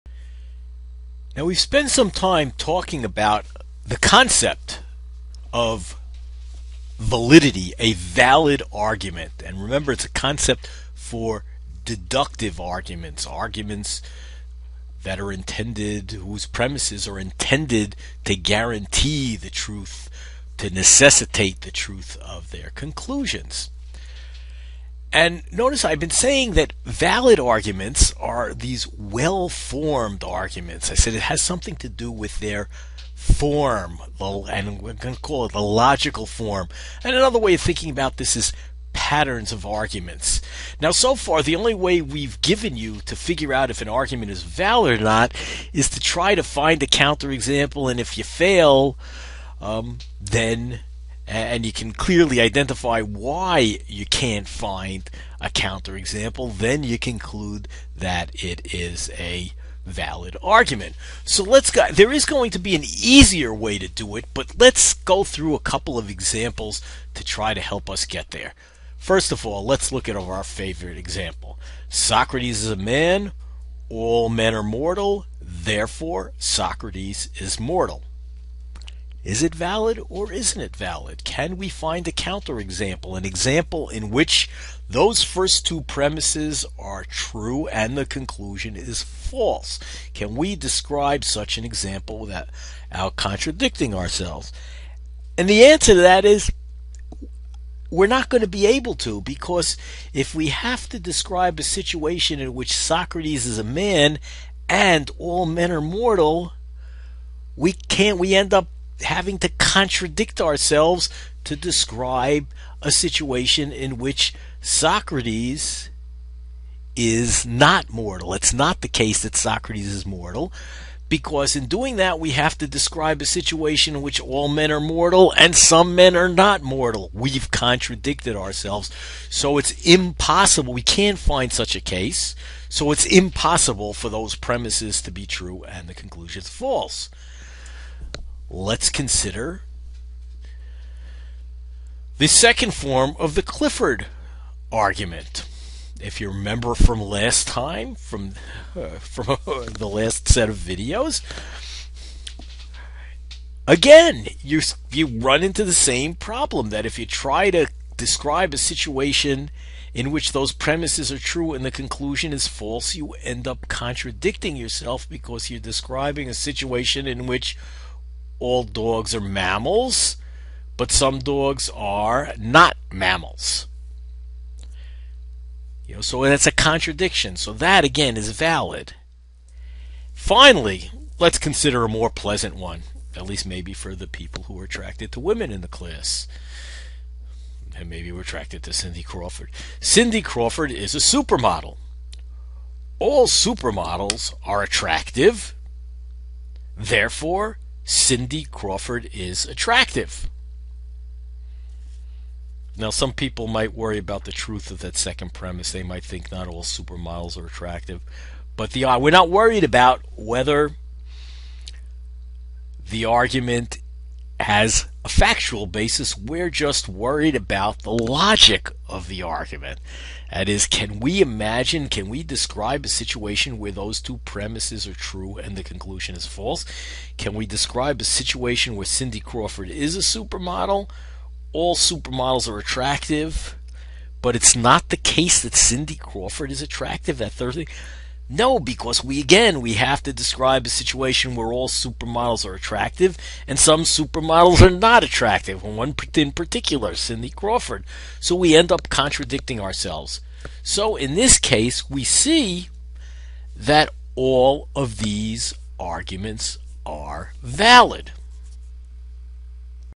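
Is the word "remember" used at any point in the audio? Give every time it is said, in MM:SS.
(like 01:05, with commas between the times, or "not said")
00:09, 02:26.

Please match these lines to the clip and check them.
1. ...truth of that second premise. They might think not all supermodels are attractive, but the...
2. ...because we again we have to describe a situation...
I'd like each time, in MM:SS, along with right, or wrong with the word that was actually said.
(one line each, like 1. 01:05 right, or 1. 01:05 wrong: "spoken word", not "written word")
1. 03:24 right
2. 03:58 right.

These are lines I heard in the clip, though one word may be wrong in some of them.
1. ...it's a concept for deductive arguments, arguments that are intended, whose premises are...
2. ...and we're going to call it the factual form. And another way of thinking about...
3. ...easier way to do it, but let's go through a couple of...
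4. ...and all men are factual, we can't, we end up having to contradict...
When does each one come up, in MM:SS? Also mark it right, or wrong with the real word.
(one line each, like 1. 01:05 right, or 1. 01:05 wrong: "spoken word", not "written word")
1. 00:09 right
2. 00:34 wrong: "logical", not "factual"
3. 01:02 right
4. 01:44 wrong: "mortal", not "factual".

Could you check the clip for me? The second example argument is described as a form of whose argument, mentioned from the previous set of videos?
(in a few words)
Clifford.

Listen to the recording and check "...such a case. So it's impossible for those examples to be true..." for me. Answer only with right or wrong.
wrong.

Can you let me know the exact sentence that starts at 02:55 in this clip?
You know, so that's a contradiction.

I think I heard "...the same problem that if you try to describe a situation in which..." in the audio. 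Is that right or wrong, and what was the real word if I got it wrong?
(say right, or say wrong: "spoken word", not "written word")
right.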